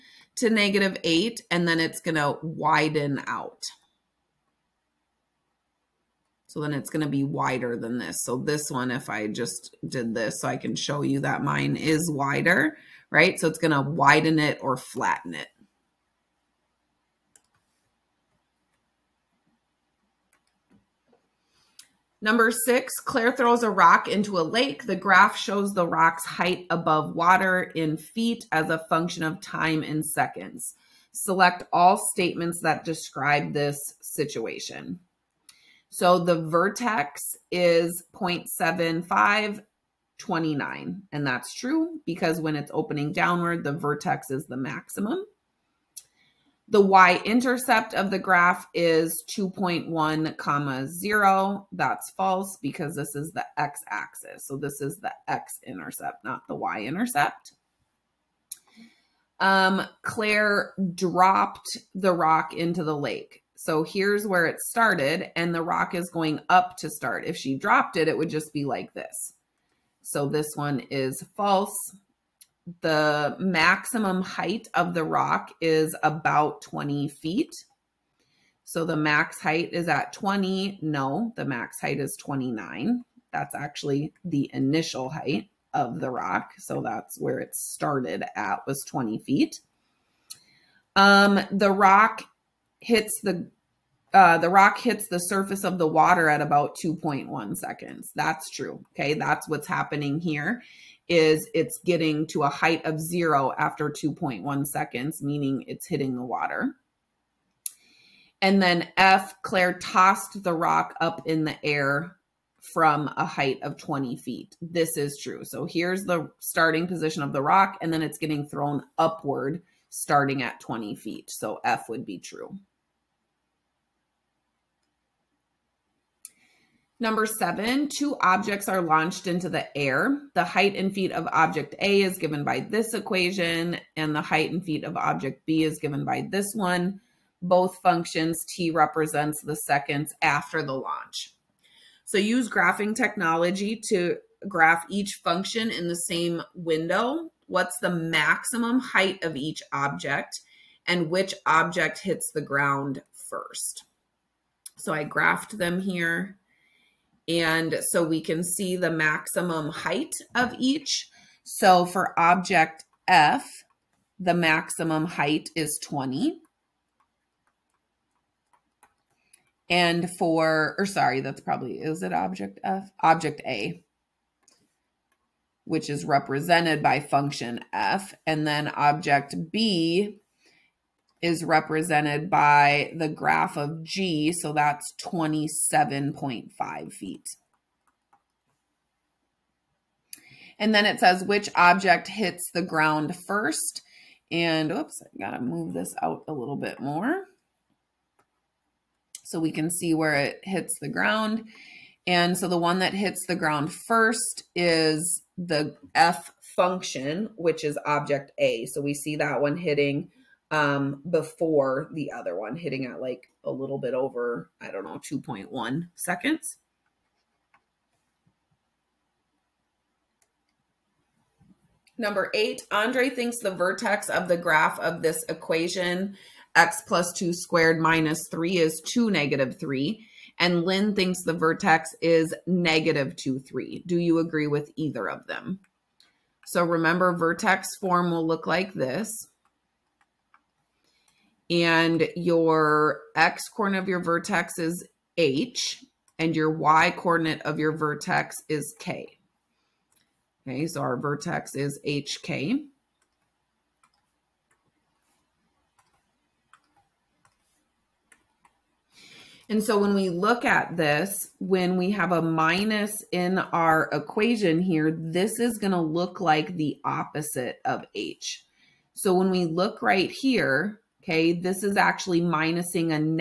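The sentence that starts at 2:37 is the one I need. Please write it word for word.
And so we can see the maximum height of each.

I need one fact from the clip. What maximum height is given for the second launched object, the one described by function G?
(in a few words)
27.5 feet.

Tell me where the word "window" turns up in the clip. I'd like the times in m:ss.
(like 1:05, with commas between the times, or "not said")
2:26.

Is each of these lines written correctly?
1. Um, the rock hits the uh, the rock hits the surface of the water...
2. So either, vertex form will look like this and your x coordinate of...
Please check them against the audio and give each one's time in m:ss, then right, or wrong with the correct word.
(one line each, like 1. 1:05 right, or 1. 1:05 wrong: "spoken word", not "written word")
1. 1:30 right
2. 3:56 wrong: "remember", not "either".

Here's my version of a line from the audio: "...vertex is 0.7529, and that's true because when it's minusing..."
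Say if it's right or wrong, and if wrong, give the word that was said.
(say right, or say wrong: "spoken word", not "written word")
wrong: "opening", not "minusing".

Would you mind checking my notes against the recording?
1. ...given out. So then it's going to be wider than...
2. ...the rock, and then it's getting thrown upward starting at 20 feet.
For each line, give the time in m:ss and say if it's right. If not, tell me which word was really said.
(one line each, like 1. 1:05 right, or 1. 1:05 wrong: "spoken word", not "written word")
1. 0:02 wrong: "widen", not "given"
2. 1:57 right.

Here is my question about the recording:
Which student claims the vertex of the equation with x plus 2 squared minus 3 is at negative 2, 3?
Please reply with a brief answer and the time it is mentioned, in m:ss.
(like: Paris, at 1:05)
Lynn, at 3:50.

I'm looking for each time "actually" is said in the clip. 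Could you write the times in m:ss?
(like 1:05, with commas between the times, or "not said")
1:23, 4:31.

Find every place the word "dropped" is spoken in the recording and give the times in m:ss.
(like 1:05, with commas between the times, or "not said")
1:00, 1:07.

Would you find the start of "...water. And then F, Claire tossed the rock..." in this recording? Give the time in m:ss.
1:46.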